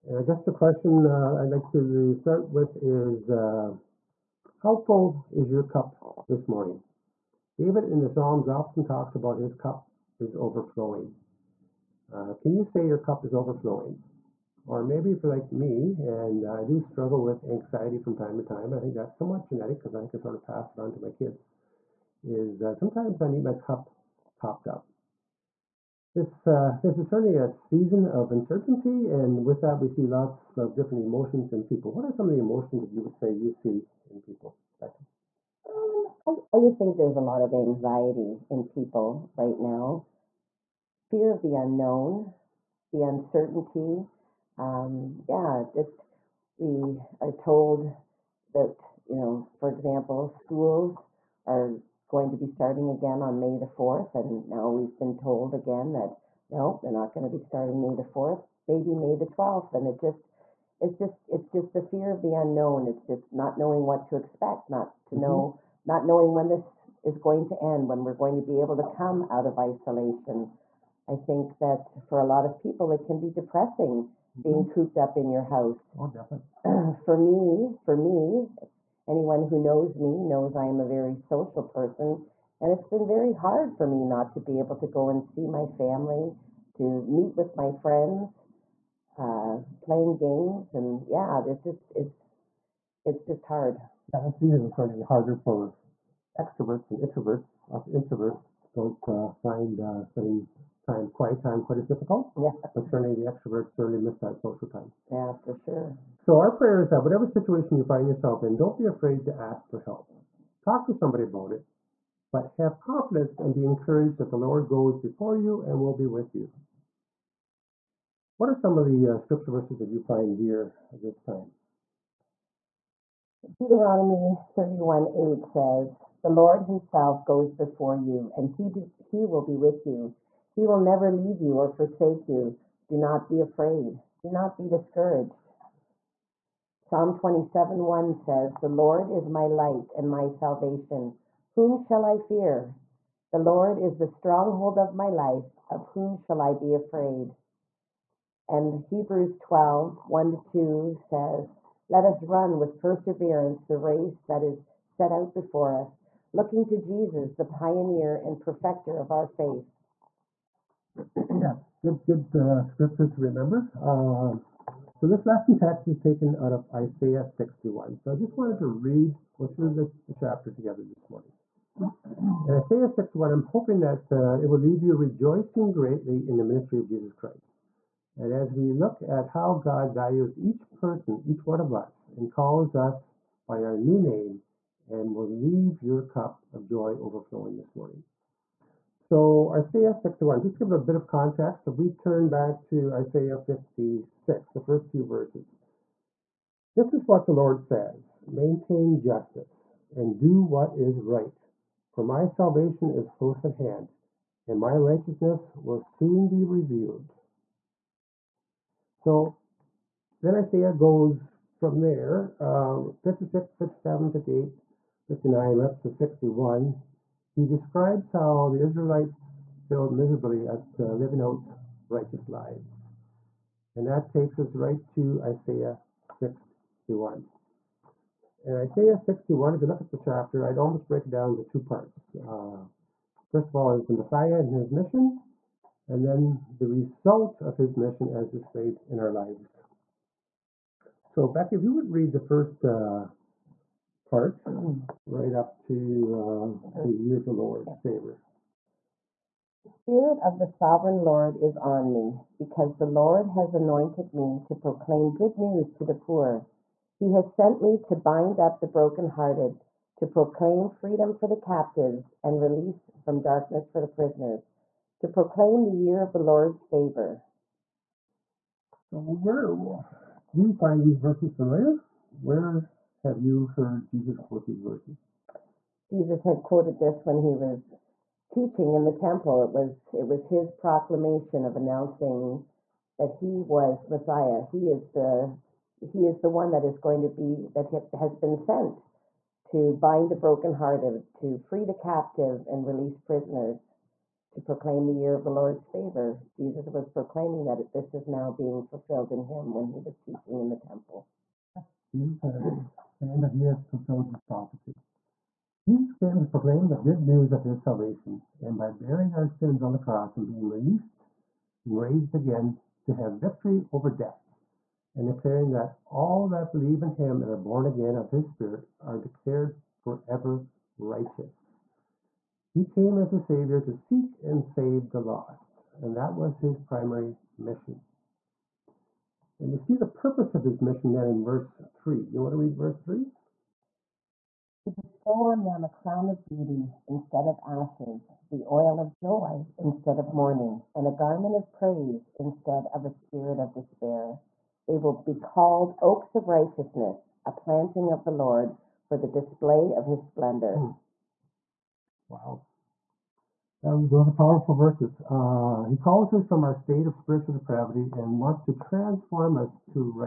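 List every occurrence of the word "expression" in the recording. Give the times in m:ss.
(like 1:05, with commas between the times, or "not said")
not said.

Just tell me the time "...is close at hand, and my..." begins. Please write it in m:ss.
3:22.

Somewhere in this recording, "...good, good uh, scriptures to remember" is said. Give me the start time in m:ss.
2:41.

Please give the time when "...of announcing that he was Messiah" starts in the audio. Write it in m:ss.
4:41.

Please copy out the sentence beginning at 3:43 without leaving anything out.
And that takes us right to Isaiah 61.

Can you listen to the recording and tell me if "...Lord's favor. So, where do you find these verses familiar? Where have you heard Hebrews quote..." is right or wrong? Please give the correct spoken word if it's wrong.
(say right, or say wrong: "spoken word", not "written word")
wrong: "Jesus", not "Hebrews".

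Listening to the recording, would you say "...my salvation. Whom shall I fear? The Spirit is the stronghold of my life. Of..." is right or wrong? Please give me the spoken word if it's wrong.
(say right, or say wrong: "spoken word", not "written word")
wrong: "Lord", not "Spirit".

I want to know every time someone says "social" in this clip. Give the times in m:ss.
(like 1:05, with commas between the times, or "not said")
1:21, 1:44.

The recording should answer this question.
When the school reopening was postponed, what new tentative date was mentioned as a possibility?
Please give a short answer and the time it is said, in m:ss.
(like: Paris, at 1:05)
May 12, at 0:58.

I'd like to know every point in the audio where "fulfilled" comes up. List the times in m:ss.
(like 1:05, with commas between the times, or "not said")
4:58, 5:03.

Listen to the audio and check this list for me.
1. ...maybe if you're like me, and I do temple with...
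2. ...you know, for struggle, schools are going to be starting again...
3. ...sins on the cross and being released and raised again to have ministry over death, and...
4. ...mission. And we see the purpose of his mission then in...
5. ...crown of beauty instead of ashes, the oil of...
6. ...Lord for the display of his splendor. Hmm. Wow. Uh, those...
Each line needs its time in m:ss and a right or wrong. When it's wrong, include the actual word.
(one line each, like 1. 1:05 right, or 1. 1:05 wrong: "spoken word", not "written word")
1. 0:14 wrong: "struggle", not "temple"
2. 0:49 wrong: "example", not "struggle"
3. 5:09 wrong: "victory", not "ministry"
4. 5:27 right
5. 5:35 right
6. 5:48 right.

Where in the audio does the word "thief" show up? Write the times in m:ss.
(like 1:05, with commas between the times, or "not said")
not said.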